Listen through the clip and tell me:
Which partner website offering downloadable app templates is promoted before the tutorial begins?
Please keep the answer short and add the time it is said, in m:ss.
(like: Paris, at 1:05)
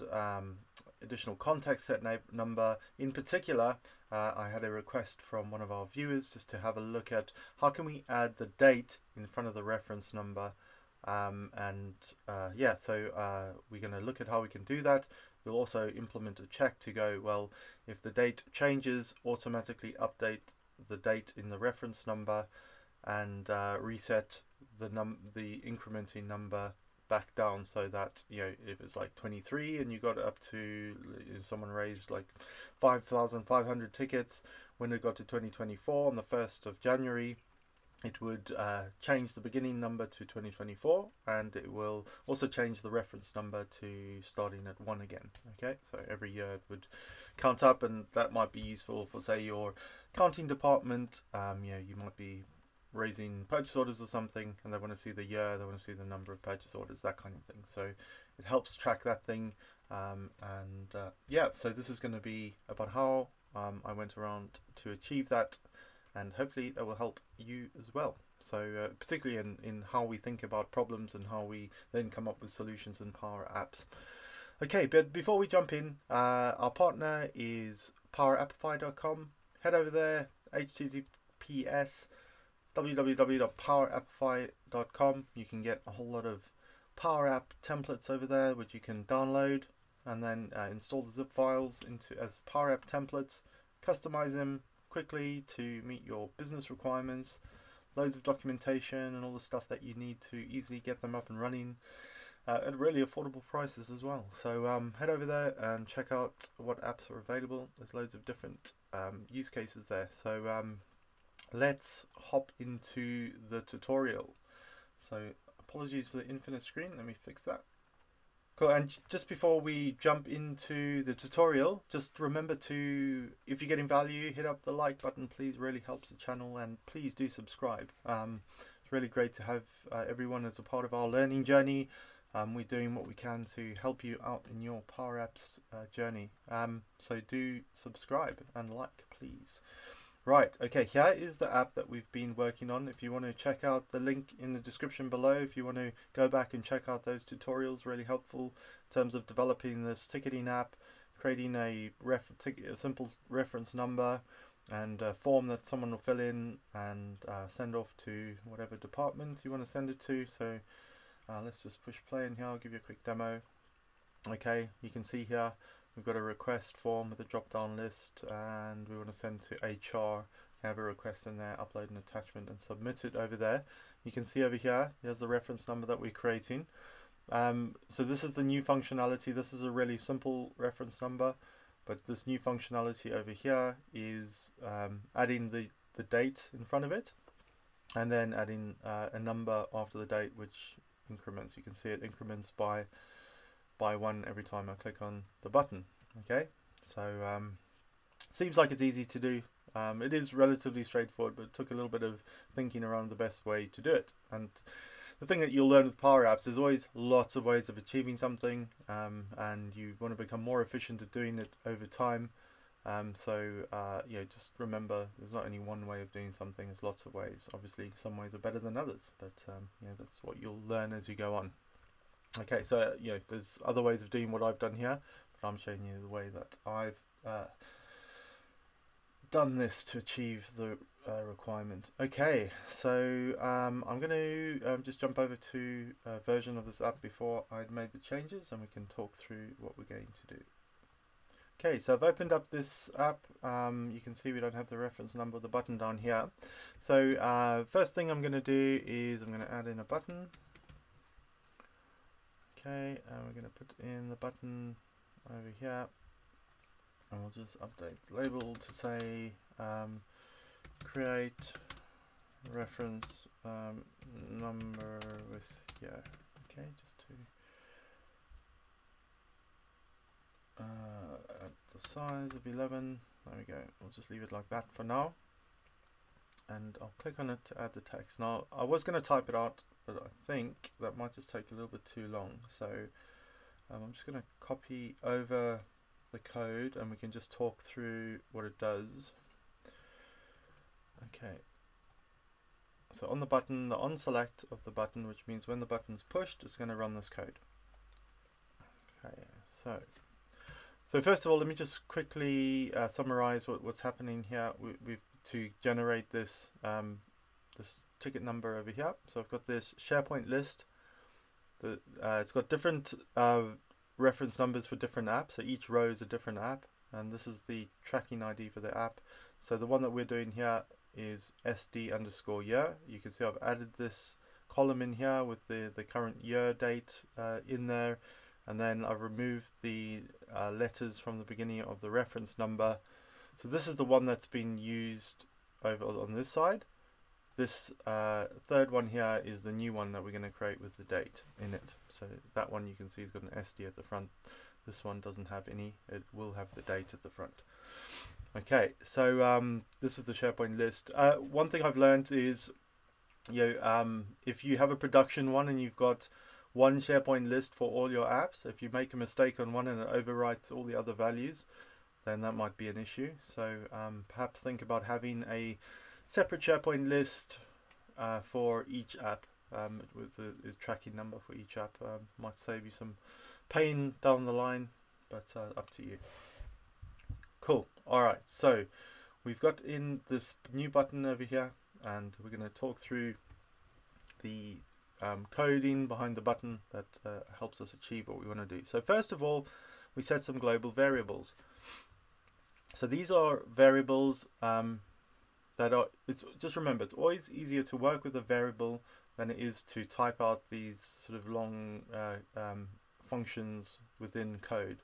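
PowerAppify.com, at 1:18.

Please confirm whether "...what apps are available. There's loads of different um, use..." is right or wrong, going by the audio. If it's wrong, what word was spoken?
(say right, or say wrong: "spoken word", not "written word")
right.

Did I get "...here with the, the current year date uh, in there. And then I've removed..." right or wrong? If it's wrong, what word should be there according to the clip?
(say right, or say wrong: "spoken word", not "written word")
right.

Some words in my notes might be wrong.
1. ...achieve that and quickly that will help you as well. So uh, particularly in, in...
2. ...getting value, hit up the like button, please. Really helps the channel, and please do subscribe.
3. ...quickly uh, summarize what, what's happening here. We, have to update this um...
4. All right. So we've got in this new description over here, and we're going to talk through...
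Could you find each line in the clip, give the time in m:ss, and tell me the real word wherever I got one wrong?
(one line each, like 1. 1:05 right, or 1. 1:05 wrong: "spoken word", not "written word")
1. 1:04 wrong: "hopefully", not "quickly"
2. 2:03 right
3. 5:01 wrong: "generate", not "update"
4. 6:17 wrong: "button", not "description".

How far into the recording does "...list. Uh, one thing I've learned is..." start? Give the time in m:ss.
5:50.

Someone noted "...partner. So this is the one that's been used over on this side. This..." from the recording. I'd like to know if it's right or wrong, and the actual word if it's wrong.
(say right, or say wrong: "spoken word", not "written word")
wrong: "number", not "partner".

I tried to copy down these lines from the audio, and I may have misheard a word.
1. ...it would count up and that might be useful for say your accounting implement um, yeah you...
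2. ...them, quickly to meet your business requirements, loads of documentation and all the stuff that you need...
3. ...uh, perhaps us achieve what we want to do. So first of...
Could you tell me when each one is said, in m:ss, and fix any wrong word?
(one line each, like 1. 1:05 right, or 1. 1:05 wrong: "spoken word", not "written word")
1. 0:46 wrong: "department", not "implement"
2. 1:34 right
3. 6:27 wrong: "helps", not "perhaps".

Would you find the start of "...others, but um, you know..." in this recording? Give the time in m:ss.
3:38.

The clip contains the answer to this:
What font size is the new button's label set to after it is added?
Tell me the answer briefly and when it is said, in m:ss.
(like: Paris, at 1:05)
11, at 4:32.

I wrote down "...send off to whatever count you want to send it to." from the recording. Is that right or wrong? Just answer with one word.
wrong.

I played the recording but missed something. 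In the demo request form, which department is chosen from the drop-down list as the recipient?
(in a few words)
HR.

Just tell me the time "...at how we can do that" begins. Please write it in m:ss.
0:14.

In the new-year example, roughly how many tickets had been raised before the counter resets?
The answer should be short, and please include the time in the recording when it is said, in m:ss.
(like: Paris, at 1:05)
5500, at 0:32.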